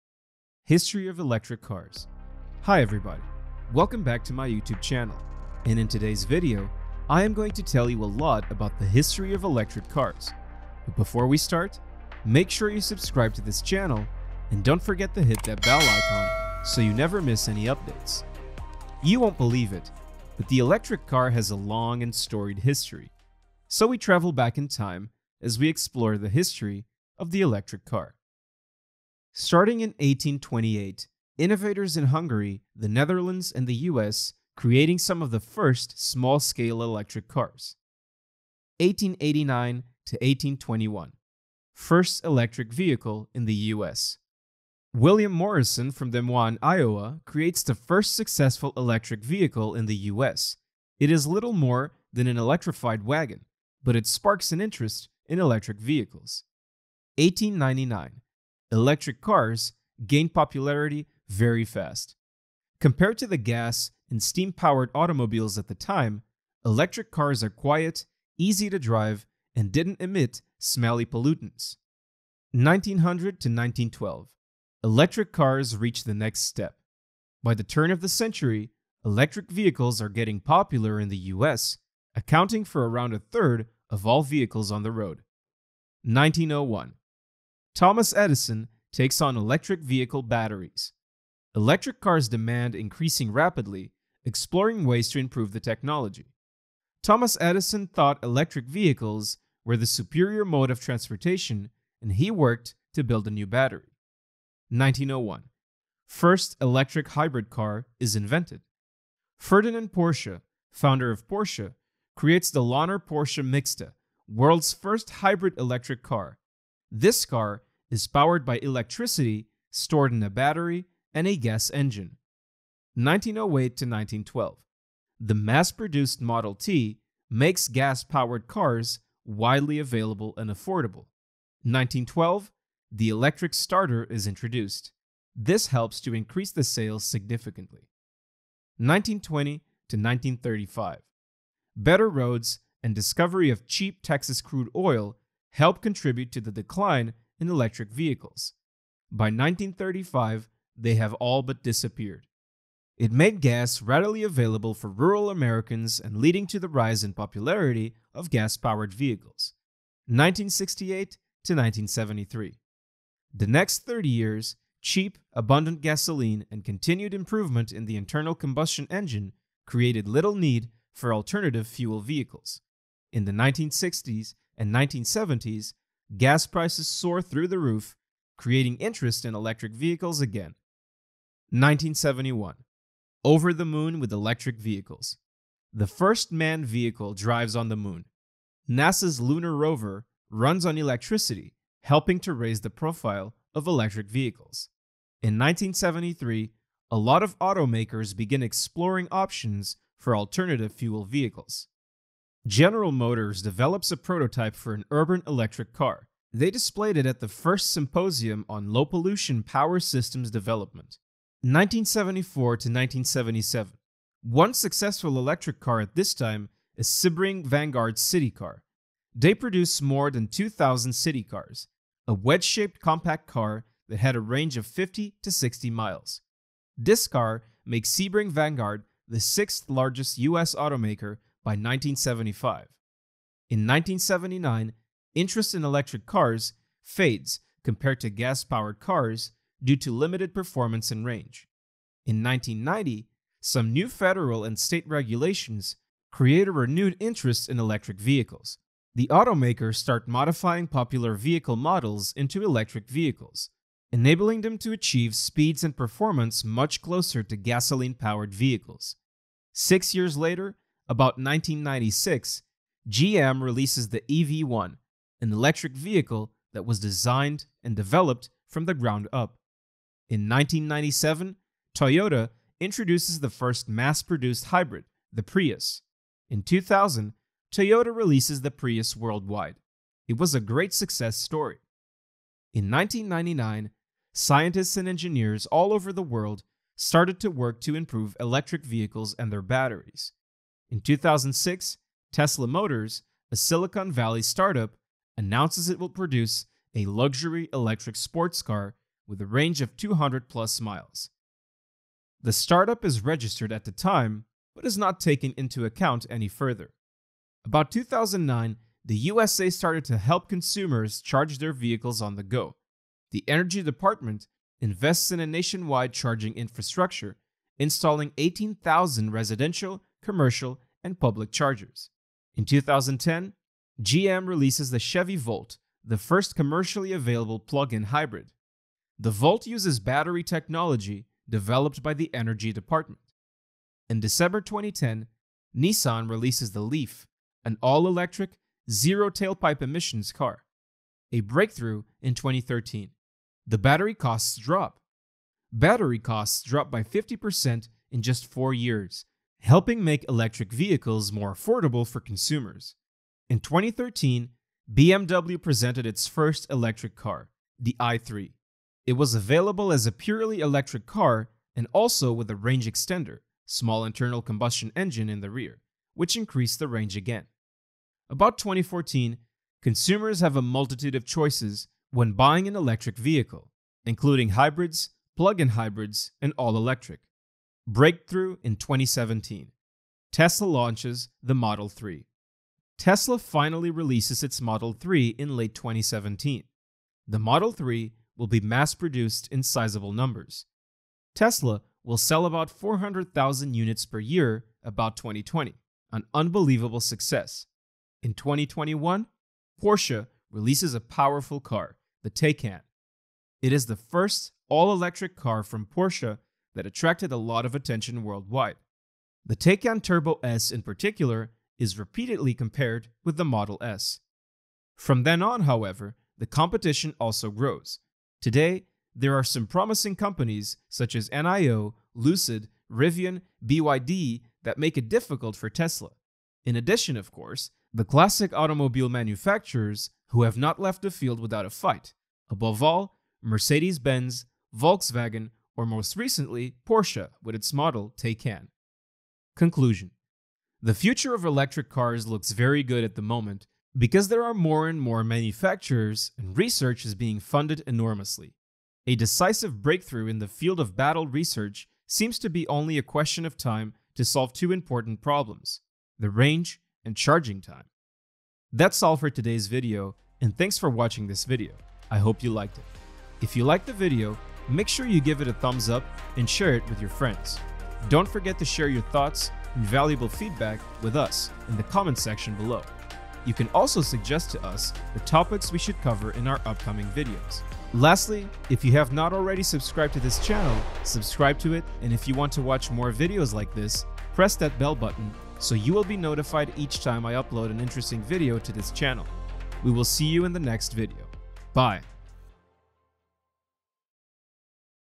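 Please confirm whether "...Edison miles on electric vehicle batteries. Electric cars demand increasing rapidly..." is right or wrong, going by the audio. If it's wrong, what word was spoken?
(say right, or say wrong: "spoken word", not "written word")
wrong: "takes", not "miles".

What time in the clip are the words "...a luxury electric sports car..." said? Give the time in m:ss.
4:56.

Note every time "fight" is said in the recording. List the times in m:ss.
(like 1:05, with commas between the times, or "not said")
7:11.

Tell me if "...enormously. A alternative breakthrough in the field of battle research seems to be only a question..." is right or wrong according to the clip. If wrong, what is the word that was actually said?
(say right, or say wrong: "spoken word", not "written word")
wrong: "decisive", not "alternative".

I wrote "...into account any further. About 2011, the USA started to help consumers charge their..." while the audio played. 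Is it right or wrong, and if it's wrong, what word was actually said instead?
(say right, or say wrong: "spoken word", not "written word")
wrong: "2009", not "2011".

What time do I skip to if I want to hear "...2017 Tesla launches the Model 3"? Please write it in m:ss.
6:18.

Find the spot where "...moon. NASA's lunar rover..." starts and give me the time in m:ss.
3:07.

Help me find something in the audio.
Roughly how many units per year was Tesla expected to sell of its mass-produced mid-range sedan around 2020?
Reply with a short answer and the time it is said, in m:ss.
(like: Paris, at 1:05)
400,000, at 6:32.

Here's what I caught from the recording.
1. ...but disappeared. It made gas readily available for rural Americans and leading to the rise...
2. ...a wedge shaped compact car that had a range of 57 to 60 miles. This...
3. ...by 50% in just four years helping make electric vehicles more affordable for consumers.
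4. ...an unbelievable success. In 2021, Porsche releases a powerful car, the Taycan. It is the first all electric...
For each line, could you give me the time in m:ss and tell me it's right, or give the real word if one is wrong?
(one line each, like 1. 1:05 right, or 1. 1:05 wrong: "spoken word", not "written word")
1. 2:31 right
2. 3:42 wrong: "50", not "57"
3. 5:46 right
4. 6:35 right.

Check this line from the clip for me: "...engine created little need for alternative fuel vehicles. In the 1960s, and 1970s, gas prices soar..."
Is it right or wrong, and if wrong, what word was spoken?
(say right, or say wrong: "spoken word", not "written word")
right.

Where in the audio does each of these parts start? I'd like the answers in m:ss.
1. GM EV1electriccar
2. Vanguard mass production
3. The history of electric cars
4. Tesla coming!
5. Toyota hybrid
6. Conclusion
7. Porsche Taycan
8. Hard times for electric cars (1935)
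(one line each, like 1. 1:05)
1. 4:24
2. 3:34
3. 0:34
4. 4:53
5. 4:34
6. 7:19
7. 6:42
8. 2:34.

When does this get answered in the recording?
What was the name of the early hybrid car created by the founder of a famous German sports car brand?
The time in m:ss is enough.
1:52.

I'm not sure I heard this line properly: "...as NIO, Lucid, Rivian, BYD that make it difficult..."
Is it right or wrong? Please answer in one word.
right.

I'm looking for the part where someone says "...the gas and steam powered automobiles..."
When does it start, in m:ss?
1:03.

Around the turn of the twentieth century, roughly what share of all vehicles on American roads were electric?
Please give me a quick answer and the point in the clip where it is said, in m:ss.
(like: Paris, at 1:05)
a third, at 1:23.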